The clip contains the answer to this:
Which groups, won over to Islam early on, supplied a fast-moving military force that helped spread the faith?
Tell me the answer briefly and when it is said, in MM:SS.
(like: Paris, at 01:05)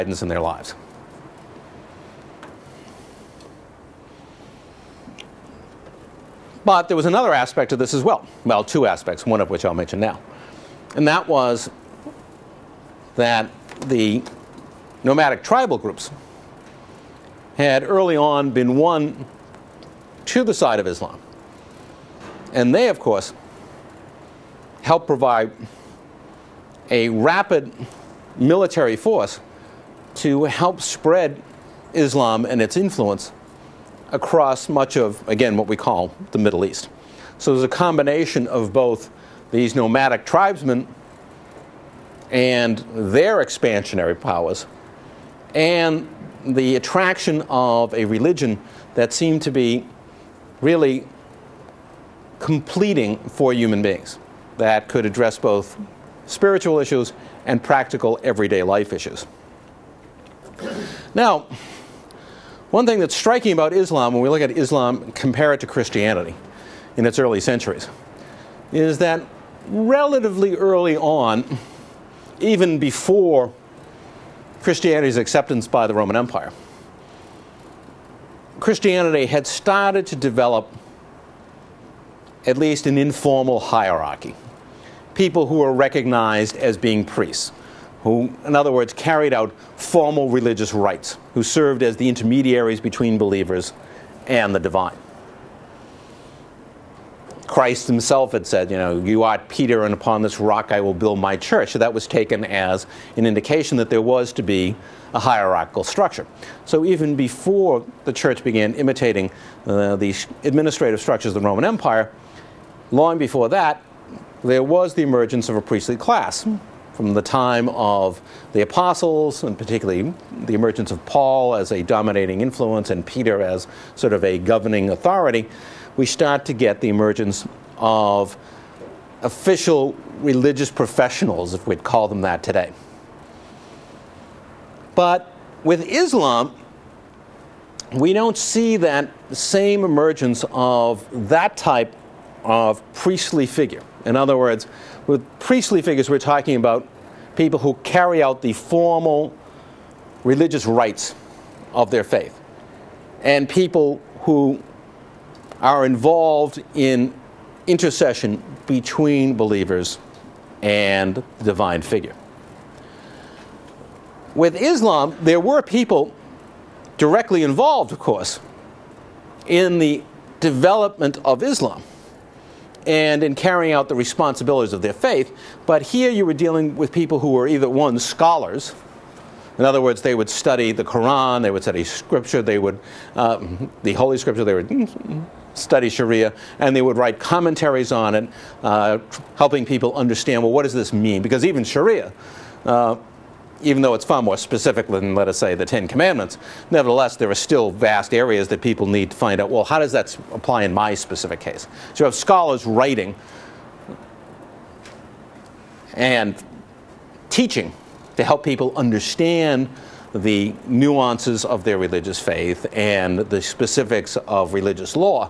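Nomadic tribal groups, at 00:15.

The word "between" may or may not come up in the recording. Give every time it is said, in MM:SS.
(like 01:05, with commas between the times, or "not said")
01:32, 02:38.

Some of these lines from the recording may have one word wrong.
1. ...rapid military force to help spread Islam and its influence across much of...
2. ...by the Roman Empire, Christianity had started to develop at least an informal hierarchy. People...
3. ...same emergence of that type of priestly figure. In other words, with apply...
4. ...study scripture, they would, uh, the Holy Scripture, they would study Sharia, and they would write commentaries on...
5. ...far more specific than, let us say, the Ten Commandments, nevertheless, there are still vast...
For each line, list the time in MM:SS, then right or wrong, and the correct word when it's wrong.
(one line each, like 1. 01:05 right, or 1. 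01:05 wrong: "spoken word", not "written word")
1. 00:27 right
2. 01:15 right
3. 02:19 wrong: "priestly", not "apply"
4. 03:01 right
5. 03:14 right.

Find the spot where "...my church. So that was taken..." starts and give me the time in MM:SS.
01:41.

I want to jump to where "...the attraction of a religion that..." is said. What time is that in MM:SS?
00:46.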